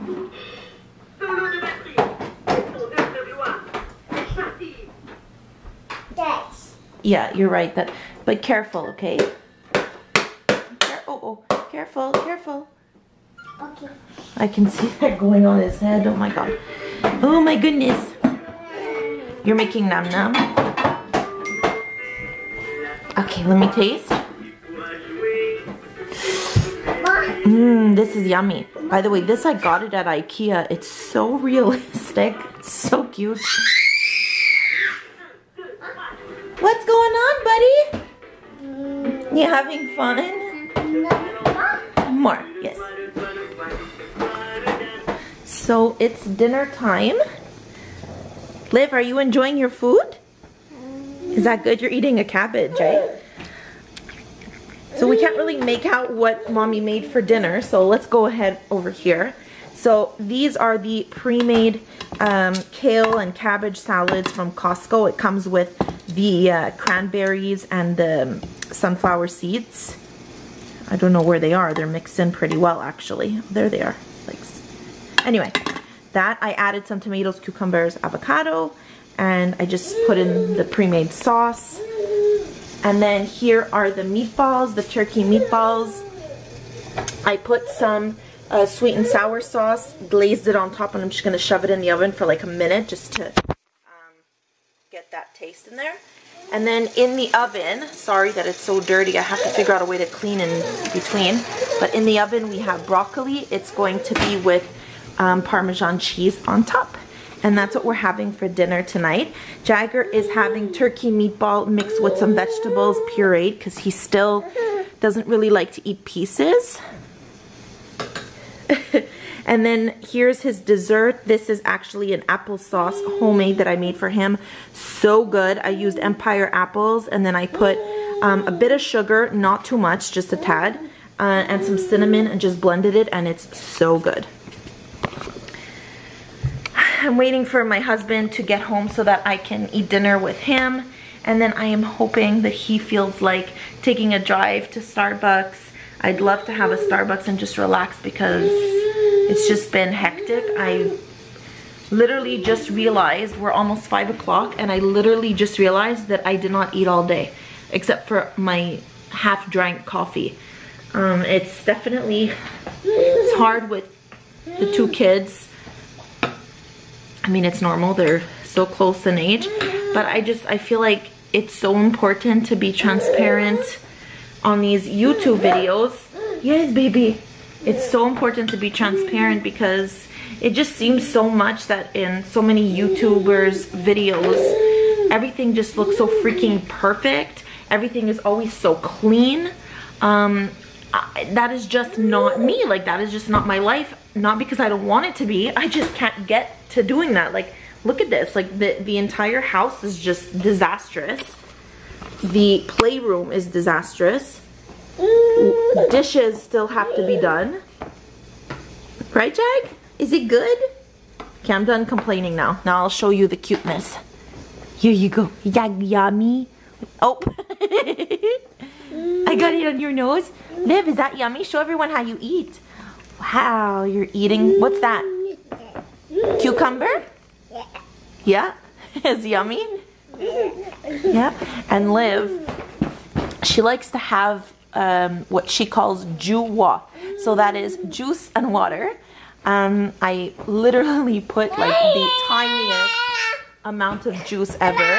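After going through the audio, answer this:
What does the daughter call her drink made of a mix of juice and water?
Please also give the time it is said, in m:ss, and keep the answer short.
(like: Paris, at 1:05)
juwa, at 3:56.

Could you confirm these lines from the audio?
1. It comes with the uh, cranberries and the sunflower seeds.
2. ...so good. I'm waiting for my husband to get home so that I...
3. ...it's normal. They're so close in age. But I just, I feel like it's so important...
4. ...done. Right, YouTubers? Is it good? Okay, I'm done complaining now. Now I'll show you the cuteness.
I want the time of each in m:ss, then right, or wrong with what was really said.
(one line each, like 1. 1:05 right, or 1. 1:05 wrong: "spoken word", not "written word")
1. 1:05 right
2. 2:13 right
3. 2:47 right
4. 3:27 wrong: "Jag", not "YouTubers".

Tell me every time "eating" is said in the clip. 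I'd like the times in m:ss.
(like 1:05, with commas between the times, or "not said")
0:51, 3:44.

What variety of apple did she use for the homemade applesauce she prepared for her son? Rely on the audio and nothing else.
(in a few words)
Empire.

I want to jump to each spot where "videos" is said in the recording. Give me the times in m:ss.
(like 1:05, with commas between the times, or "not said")
2:55, 3:03.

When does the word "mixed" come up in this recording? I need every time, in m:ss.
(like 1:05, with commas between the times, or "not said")
1:11, 1:51.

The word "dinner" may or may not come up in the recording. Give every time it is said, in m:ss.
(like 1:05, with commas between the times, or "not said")
0:46, 0:57, 1:48, 2:19.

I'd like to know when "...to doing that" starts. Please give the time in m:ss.
3:16.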